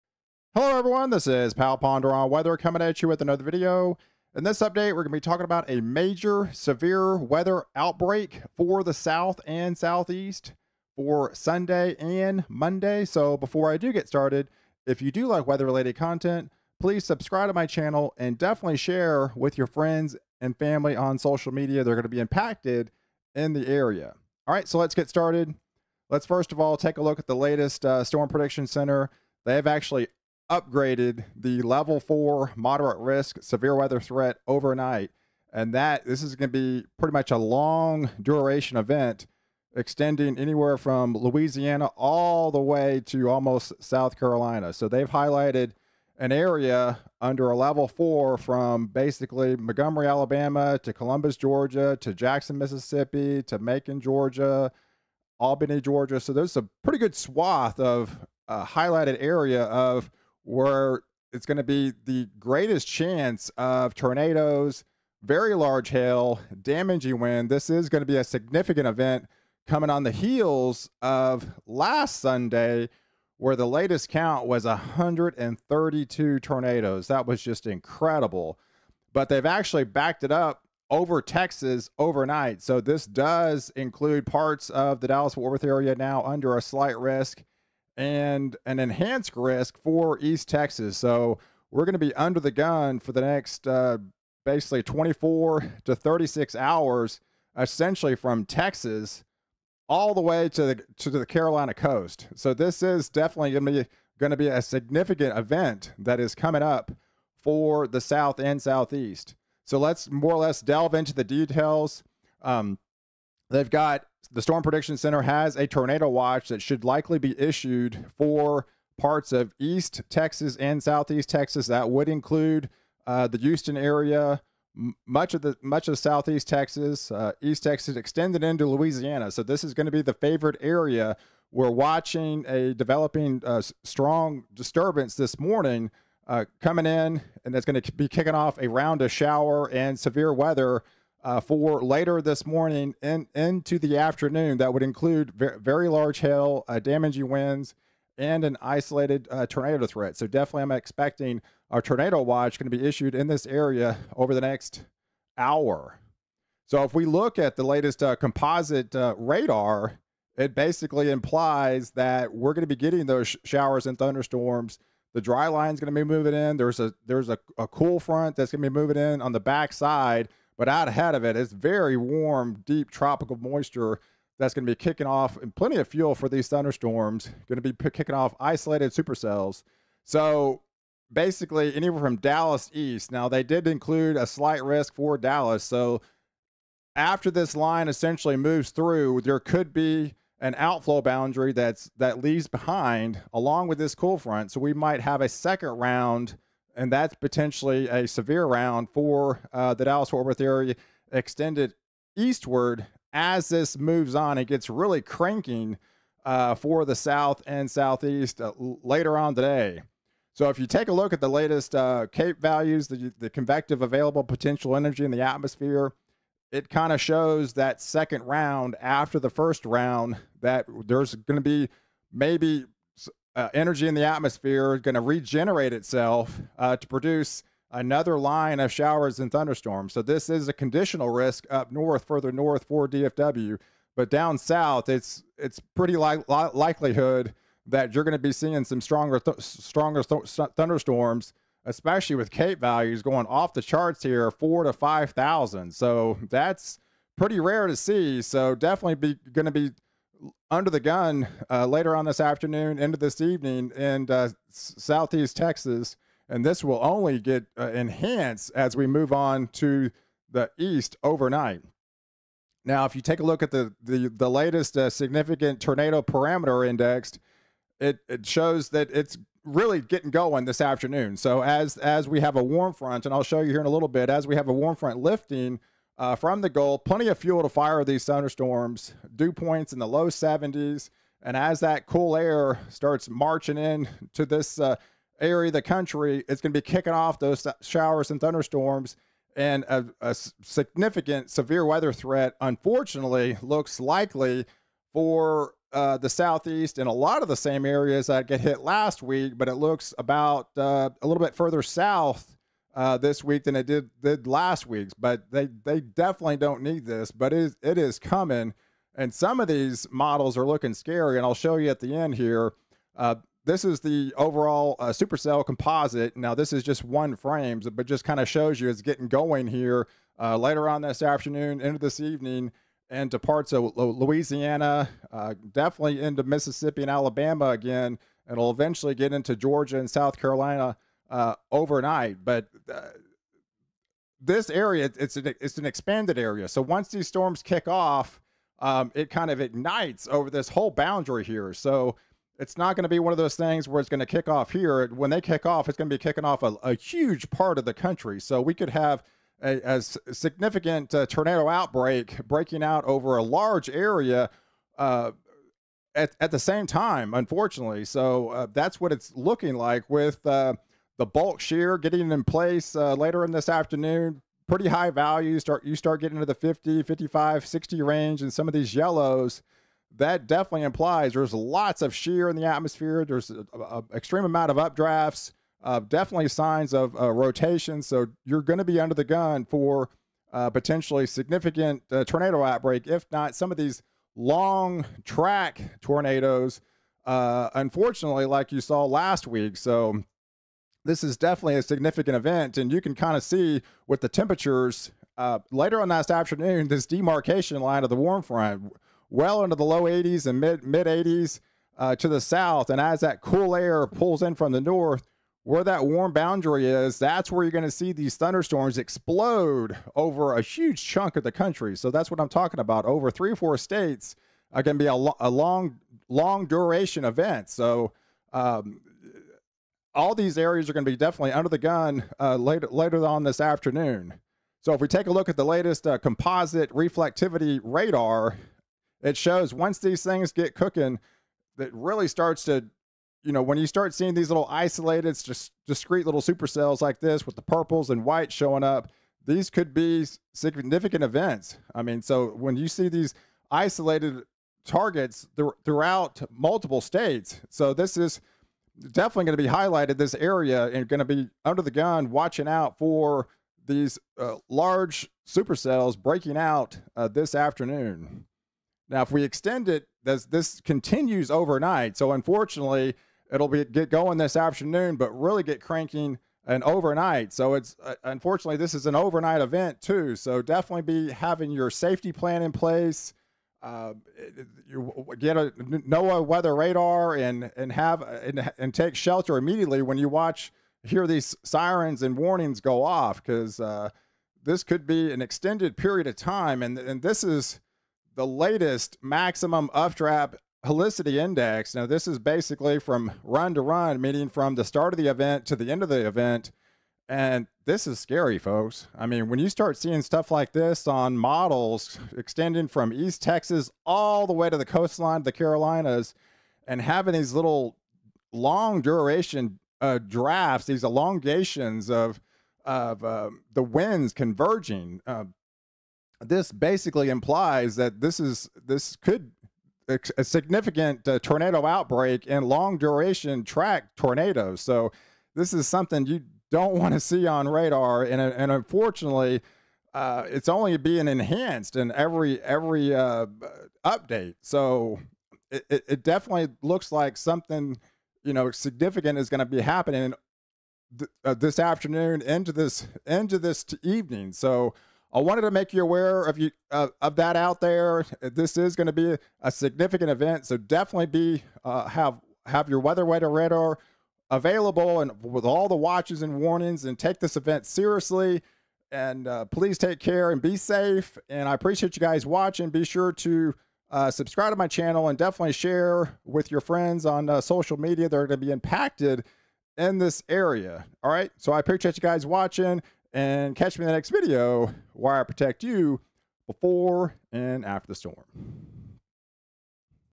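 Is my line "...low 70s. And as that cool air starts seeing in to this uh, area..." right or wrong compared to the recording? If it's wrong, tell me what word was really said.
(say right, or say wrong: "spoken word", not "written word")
wrong: "marching", not "seeing".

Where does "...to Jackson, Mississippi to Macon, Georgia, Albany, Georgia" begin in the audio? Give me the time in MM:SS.
00:52.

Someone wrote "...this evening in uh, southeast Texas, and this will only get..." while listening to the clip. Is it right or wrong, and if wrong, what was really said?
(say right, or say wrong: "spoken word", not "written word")
right.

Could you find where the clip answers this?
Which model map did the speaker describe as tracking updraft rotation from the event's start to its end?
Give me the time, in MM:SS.
08:09.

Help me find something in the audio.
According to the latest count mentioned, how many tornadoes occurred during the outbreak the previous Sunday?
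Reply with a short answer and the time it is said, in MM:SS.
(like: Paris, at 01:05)
132, at 01:14.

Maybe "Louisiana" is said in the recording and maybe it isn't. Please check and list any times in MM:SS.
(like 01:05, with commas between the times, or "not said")
00:41, 02:08, 05:23.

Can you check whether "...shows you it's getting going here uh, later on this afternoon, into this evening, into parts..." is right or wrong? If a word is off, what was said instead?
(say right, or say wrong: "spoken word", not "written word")
right.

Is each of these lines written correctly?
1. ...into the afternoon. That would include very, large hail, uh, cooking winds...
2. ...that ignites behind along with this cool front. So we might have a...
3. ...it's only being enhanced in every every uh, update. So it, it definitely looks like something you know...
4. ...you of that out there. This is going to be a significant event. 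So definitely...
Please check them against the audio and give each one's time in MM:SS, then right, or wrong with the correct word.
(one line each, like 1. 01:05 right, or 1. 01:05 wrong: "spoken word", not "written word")
1. 02:23 wrong: "damaging", not "cooking"
2. 03:11 wrong: "leaves", not "ignites"
3. 08:50 right
4. 09:06 right.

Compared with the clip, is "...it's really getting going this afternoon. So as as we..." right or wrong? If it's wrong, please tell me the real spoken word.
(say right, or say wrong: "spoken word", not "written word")
right.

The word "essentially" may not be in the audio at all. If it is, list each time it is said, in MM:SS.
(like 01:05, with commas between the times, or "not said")
01:37, 03:07.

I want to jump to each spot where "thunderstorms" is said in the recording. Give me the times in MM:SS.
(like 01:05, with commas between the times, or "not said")
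02:43, 02:56, 03:49, 04:00, 04:38, 04:48, 06:48.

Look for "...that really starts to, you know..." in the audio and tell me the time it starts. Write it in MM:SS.
07:11.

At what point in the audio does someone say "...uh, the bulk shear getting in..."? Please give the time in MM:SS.
06:00.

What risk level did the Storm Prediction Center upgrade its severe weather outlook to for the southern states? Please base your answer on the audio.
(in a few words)
level four moderate risk.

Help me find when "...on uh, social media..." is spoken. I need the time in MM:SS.
09:27.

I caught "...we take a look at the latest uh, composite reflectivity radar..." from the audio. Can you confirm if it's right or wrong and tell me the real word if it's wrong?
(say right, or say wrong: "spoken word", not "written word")
right.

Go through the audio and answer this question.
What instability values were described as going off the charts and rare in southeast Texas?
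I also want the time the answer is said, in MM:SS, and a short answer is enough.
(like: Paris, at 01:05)
4,000 to 5,000, at 04:04.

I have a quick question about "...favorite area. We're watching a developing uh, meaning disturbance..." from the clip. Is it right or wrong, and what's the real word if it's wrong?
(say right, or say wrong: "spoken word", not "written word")
wrong: "strong", not "meaning".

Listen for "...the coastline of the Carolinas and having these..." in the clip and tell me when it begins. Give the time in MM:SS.
08:24.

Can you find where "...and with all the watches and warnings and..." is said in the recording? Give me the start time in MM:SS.
09:15.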